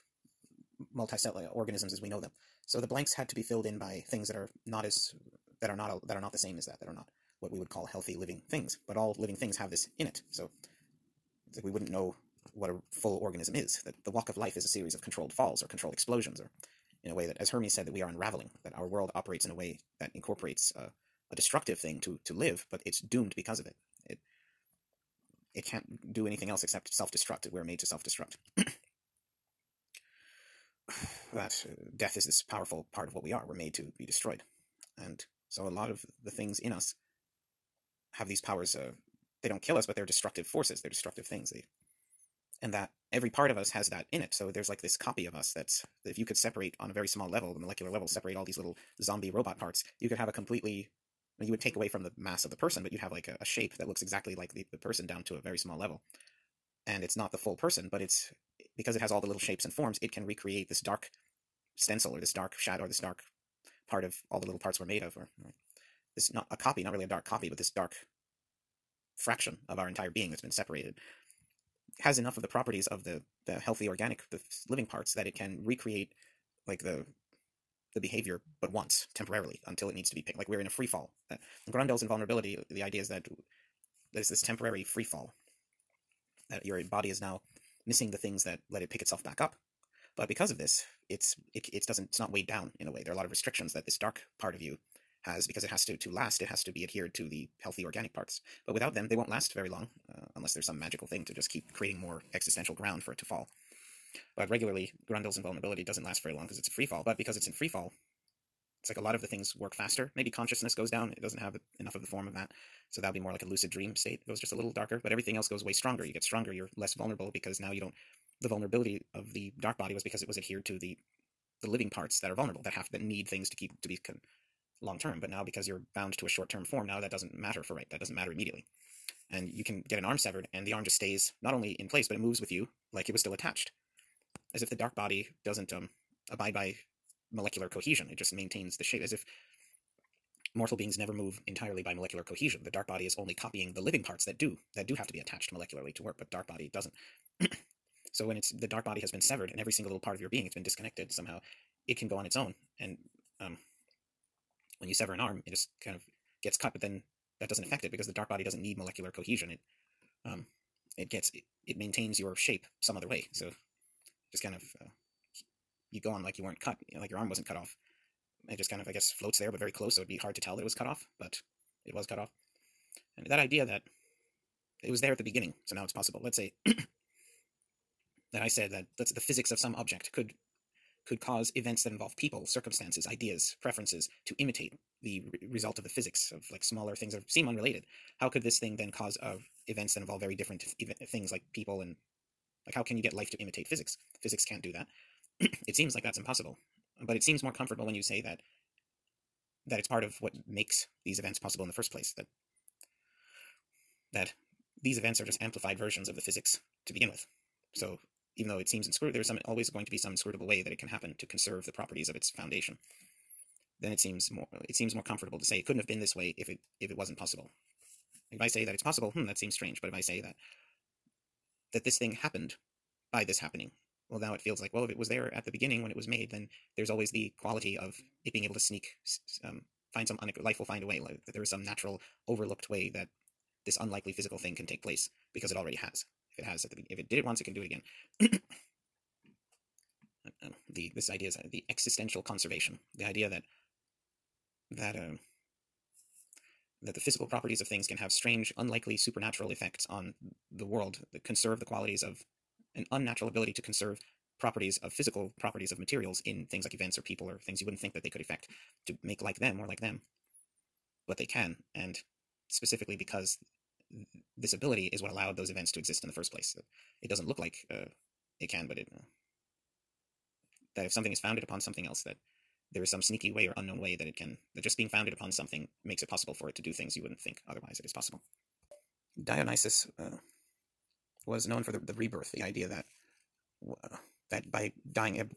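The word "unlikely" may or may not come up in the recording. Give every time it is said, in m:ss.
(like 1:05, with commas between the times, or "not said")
3:53, 4:08.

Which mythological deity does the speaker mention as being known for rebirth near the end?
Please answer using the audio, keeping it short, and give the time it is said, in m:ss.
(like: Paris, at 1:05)
Dionysus, at 4:39.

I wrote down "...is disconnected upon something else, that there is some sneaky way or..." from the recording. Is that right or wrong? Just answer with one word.
wrong.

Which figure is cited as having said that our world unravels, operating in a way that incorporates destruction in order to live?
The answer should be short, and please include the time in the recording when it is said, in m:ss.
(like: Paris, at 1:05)
Hermes, at 0:17.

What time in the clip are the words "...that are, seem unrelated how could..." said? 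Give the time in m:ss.
3:07.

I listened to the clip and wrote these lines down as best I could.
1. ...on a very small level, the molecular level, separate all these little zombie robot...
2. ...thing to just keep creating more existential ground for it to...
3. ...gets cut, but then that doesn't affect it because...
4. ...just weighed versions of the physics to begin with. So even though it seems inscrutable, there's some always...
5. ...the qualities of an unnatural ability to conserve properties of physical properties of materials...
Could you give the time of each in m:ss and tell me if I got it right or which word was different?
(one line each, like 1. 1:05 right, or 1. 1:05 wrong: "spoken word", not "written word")
1. 0:46 right
2. 1:41 right
3. 2:36 right
4. 3:25 wrong: "amplified", not "weighed"
5. 4:11 right.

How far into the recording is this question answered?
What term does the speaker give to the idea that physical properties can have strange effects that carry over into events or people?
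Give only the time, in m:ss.
4:01.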